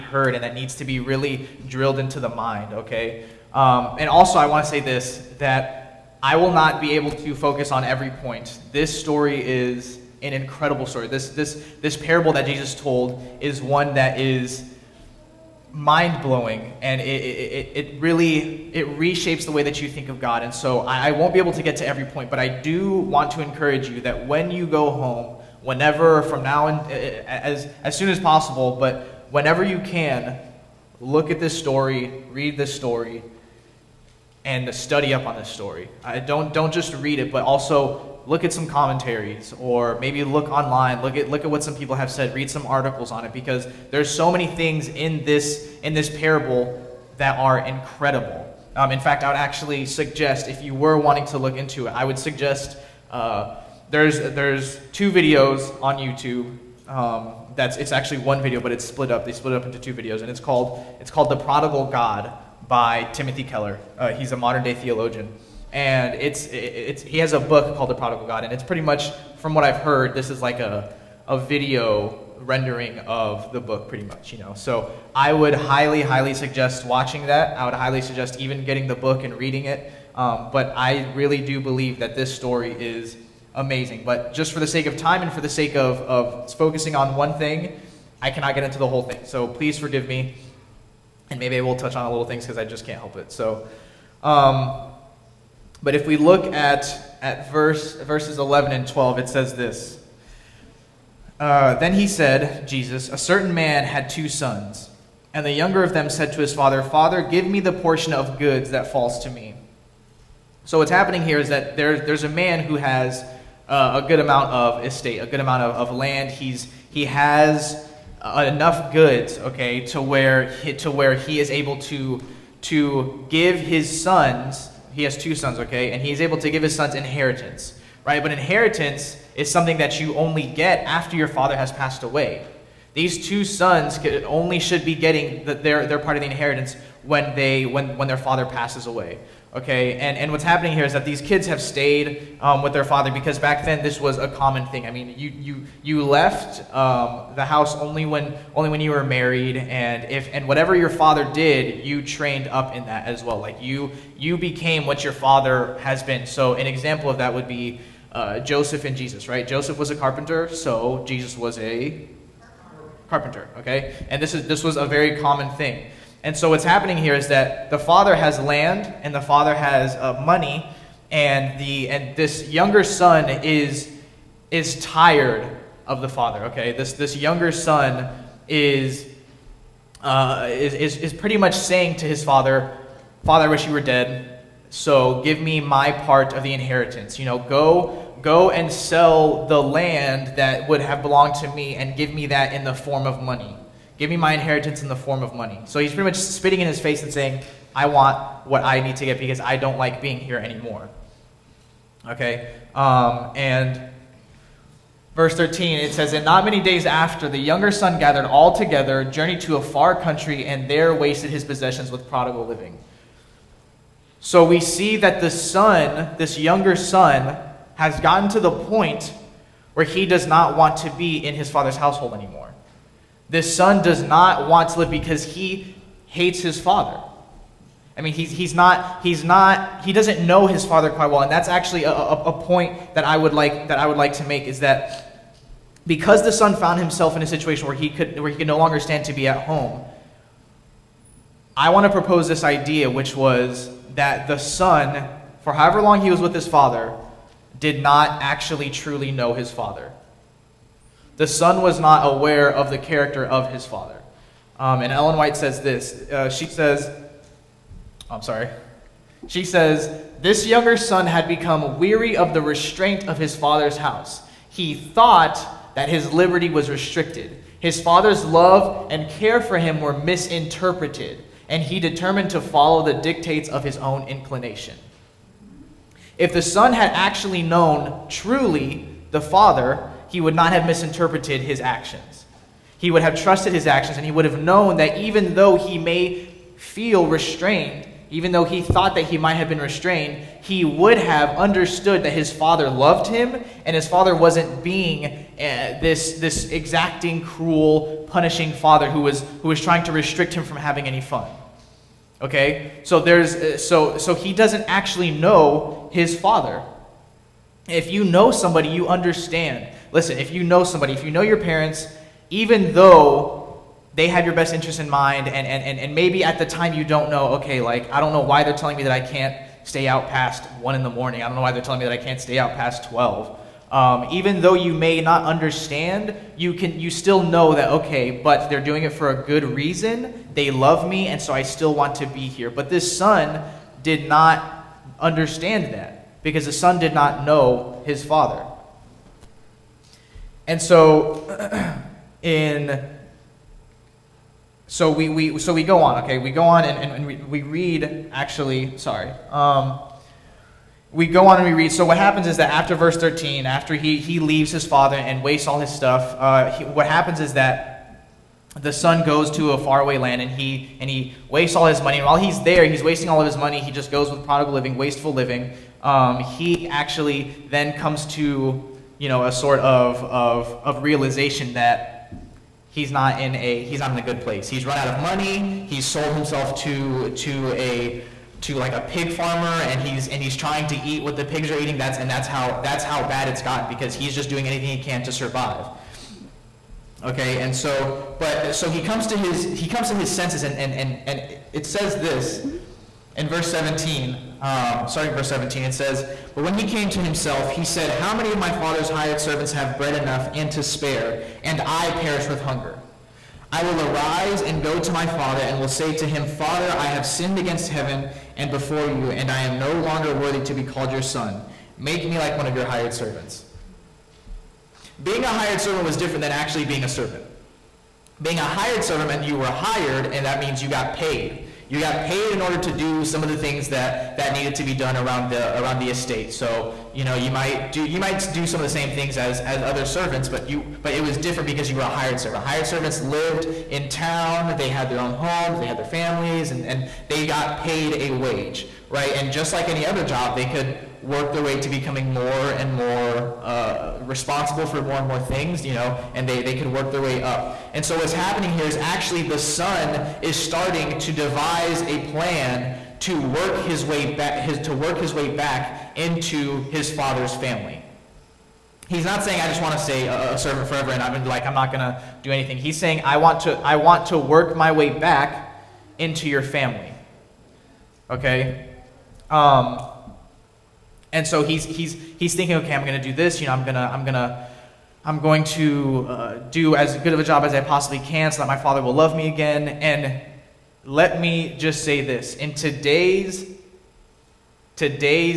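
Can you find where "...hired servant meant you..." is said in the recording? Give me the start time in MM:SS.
06:58.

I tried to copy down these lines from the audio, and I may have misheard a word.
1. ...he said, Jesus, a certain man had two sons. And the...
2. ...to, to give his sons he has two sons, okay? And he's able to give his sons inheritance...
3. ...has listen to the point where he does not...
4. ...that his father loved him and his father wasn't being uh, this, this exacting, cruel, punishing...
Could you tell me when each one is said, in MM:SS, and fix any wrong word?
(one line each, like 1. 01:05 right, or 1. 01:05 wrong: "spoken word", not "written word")
1. 01:41 right
2. 02:01 right
3. 03:37 wrong: "gotten", not "listen"
4. 04:52 right.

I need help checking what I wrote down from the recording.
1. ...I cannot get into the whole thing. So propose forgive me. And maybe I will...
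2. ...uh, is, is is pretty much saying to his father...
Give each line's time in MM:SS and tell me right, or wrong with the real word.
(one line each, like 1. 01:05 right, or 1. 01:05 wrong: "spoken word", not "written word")
1. 01:28 wrong: "please", not "propose"
2. 03:00 right.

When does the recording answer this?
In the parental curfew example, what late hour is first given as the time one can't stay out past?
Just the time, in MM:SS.
05:20.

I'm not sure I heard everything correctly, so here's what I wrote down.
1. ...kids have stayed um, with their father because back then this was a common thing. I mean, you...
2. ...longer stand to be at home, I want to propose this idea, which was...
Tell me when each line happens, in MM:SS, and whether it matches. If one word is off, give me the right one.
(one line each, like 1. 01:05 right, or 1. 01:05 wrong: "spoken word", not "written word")
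1. 02:21 right
2. 03:58 right.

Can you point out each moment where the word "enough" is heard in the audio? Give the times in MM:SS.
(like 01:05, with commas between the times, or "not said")
01:58, 06:39.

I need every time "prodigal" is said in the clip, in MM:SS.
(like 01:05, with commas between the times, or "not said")
01:01, 01:07, 03:32, 06:04.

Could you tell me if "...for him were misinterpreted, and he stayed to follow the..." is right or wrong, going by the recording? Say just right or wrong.
wrong.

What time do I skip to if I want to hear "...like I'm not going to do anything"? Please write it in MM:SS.
07:41.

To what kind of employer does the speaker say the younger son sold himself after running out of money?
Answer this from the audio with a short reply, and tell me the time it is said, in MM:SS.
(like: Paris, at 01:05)
A pig farmer, at 06:18.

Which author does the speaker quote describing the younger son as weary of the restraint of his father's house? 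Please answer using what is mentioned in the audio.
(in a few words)
Ellen White.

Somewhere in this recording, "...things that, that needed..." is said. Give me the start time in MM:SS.
07:03.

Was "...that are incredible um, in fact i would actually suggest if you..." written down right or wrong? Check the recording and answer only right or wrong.
right.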